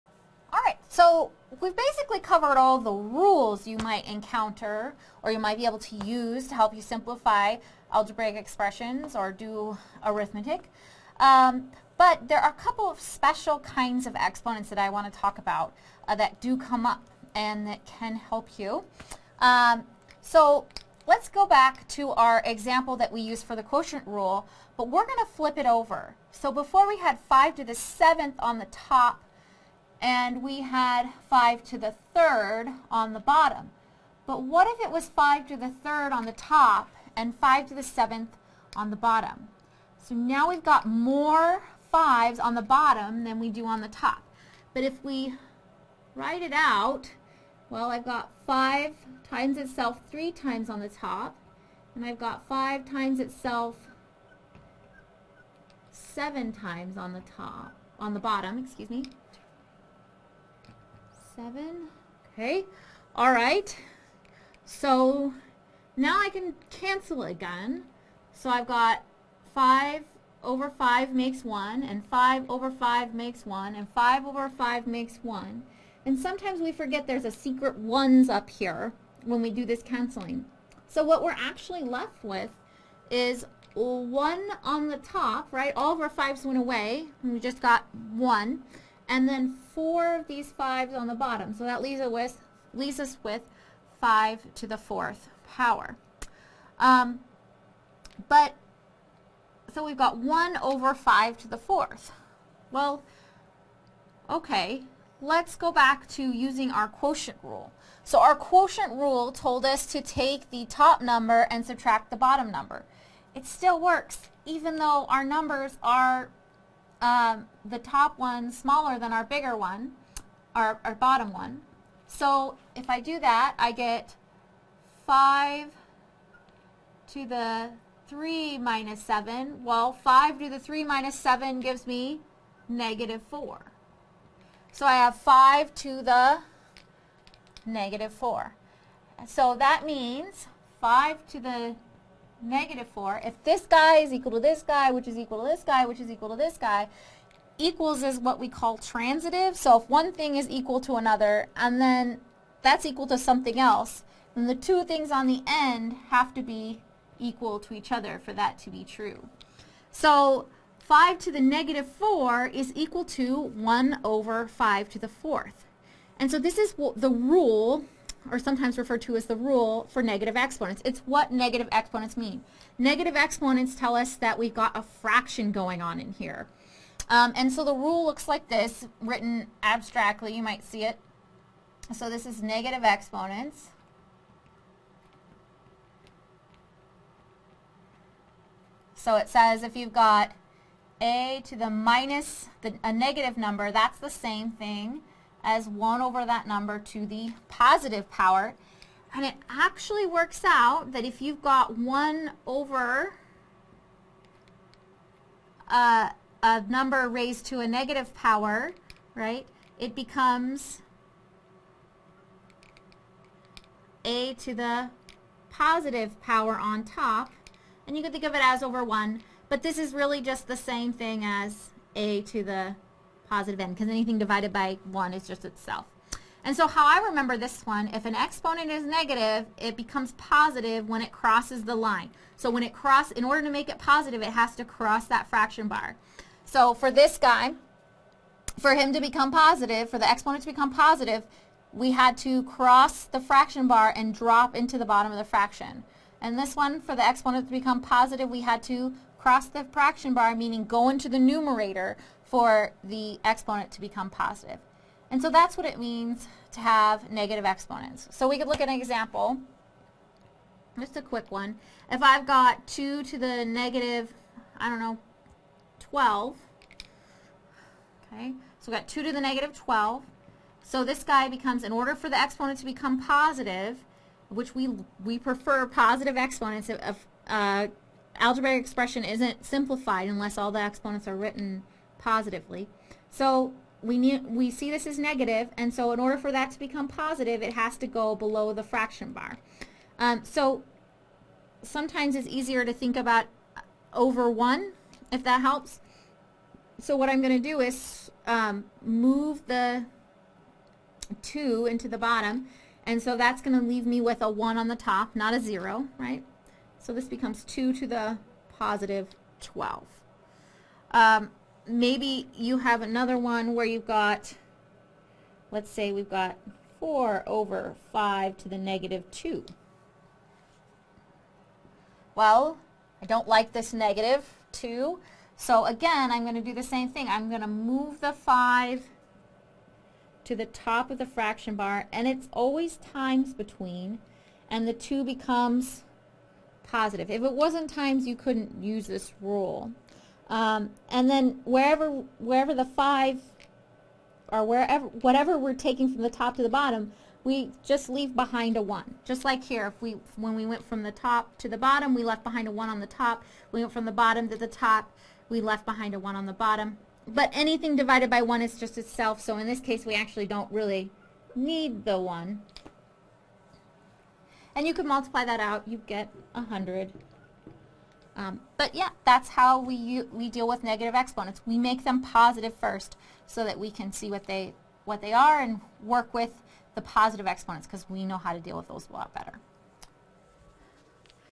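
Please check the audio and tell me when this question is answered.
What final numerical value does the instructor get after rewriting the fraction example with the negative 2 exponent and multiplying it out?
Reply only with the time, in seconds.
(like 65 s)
366 s.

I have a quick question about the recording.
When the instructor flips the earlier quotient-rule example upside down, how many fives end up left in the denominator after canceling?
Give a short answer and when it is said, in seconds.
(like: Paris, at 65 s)
4, at 89 s.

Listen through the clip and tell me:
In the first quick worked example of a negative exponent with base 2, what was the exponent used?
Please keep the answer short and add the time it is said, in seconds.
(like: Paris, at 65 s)
-12, at 263 s.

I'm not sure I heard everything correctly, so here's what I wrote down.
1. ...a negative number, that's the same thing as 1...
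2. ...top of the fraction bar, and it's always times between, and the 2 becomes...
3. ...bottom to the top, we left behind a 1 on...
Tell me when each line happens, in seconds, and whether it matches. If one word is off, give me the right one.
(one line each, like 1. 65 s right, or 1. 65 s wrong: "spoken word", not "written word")
1. 192 s right
2. 330 s right
3. 353 s right.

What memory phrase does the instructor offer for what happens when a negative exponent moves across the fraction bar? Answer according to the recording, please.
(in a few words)
it becomes positive.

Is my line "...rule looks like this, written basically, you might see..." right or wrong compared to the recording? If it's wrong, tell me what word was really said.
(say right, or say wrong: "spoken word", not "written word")
wrong: "abstractly", not "basically".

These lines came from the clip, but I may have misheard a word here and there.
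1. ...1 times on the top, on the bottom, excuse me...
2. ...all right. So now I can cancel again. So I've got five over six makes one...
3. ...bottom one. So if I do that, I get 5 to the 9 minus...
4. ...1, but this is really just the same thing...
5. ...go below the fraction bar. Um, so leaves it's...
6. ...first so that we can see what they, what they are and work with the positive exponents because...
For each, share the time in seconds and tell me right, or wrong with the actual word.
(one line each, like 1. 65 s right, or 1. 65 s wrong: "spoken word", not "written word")
1. 55 s wrong: "7", not "1"
2. 63 s wrong: "five", not "six"
3. 120 s wrong: "3", not "9"
4. 218 s right
5. 287 s wrong: "sometimes", not "leaves"
6. 372 s right.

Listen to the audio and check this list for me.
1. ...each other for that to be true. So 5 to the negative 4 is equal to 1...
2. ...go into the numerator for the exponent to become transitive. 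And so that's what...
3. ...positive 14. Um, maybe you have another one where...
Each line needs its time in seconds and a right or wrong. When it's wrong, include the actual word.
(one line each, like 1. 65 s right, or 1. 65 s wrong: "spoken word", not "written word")
1. 157 s right
2. 250 s wrong: "positive", not "transitive"
3. 308 s wrong: "12", not "14".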